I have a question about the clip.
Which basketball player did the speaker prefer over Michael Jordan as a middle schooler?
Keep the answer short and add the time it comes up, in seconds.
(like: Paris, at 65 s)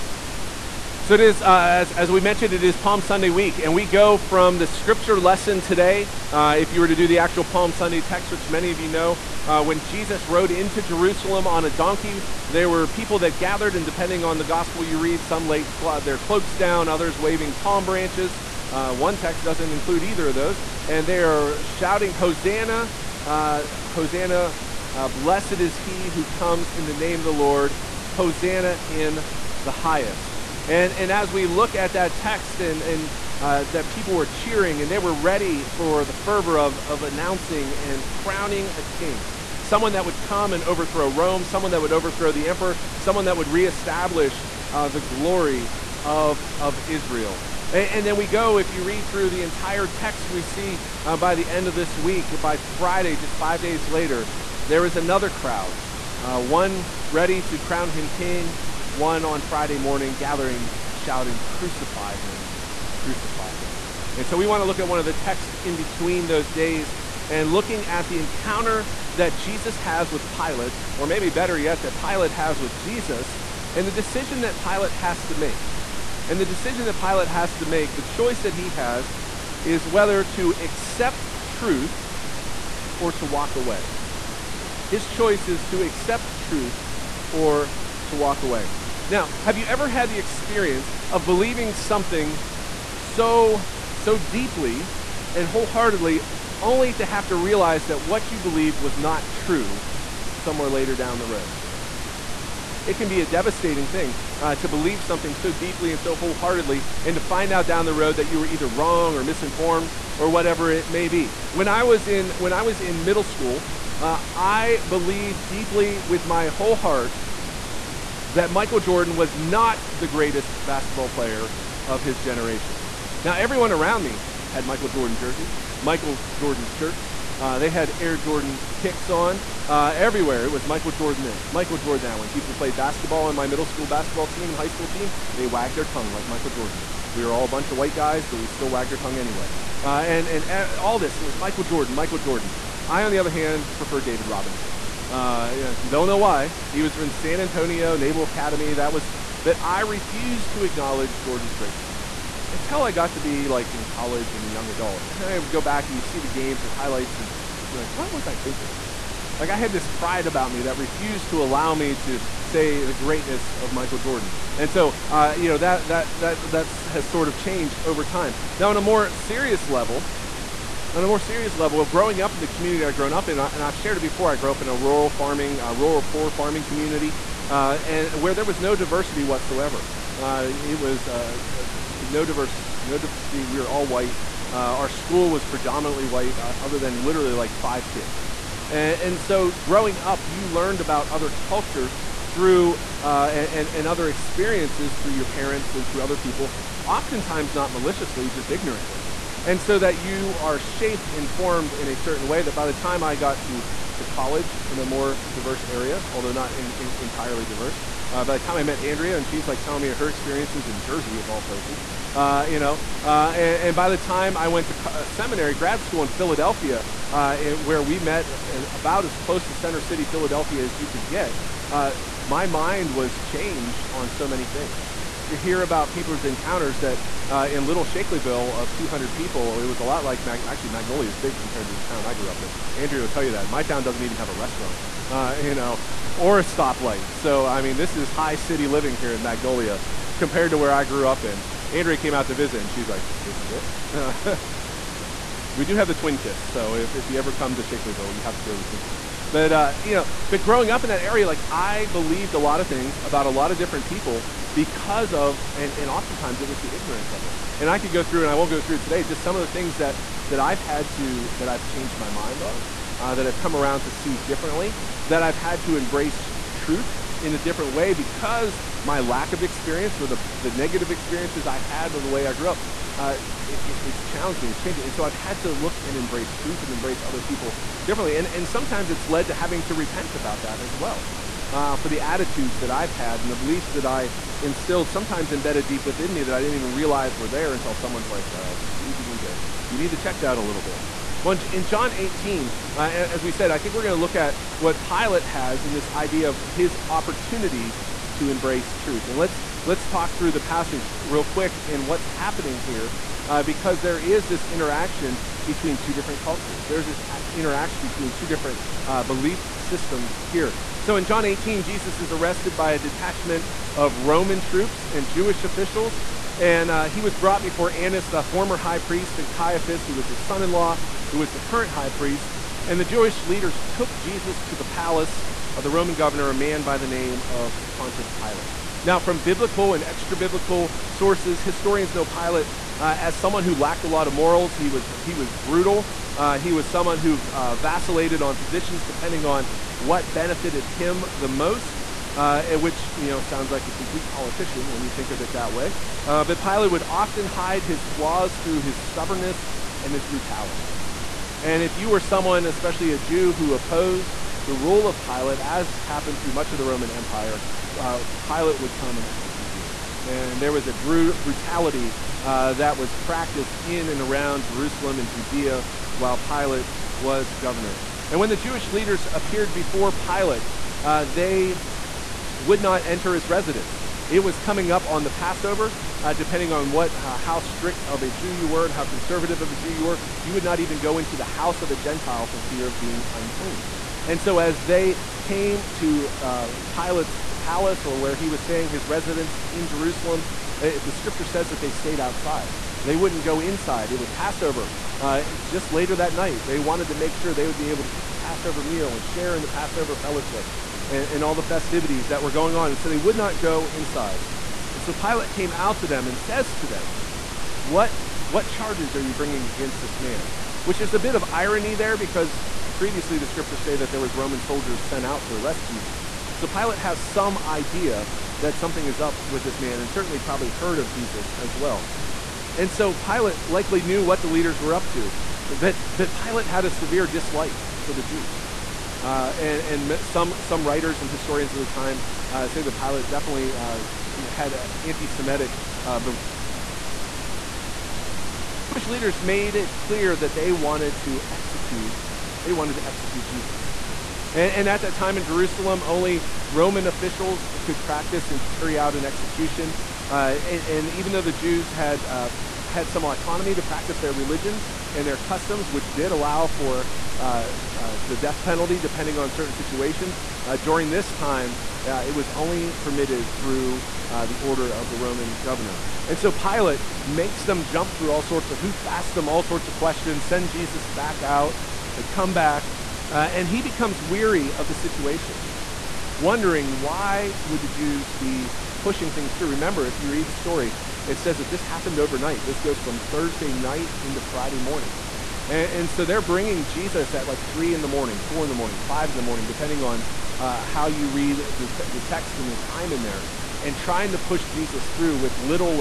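David Robinson, at 144 s.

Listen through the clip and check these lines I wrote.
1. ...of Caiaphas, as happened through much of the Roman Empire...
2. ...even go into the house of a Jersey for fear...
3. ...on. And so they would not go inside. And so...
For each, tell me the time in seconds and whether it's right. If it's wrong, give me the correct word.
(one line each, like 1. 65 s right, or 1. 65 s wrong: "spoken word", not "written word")
1. 354 s wrong: "Pilate", not "Caiaphas"
2. 380 s wrong: "Gentile", not "Jersey"
3. 402 s right.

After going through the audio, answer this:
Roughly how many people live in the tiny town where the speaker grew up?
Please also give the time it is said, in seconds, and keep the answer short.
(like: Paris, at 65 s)
200, at 228 s.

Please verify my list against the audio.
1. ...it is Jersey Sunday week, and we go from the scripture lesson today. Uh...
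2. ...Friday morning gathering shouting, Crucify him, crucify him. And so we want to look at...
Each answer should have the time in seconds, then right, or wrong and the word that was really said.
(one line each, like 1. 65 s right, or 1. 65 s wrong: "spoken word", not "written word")
1. 2 s wrong: "Palm", not "Jersey"
2. 59 s right.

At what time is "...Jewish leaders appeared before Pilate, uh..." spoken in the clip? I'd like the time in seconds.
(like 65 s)
368 s.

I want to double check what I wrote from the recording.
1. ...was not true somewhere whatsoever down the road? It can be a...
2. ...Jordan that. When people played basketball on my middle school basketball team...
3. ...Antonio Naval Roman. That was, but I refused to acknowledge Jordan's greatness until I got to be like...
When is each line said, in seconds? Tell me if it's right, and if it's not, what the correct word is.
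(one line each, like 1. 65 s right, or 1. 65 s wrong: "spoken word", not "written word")
1. 98 s wrong: "later", not "whatsoever"
2. 131 s right
3. 147 s wrong: "Academy", not "Roman".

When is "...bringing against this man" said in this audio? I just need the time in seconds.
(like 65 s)
409 s.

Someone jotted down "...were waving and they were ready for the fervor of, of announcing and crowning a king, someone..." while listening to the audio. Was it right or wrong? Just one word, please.
wrong.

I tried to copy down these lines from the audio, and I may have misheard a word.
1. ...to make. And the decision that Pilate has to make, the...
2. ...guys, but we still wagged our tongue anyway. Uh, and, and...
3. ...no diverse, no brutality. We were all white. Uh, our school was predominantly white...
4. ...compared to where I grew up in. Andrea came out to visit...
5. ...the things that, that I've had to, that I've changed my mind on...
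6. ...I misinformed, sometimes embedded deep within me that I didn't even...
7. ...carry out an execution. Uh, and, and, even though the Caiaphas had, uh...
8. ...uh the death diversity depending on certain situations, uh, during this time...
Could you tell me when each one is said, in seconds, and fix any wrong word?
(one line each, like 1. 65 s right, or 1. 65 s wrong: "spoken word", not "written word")
1. 75 s right
2. 137 s right
3. 181 s wrong: "diversity", not "brutality"
4. 240 s right
5. 259 s right
6. 283 s wrong: "instilled", not "misinformed"
7. 448 s wrong: "Jews", not "Caiaphas"
8. 457 s wrong: "penalty", not "diversity".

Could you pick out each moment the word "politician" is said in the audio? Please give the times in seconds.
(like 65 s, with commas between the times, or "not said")
344 s.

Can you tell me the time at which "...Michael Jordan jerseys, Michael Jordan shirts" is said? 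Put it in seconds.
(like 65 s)
124 s.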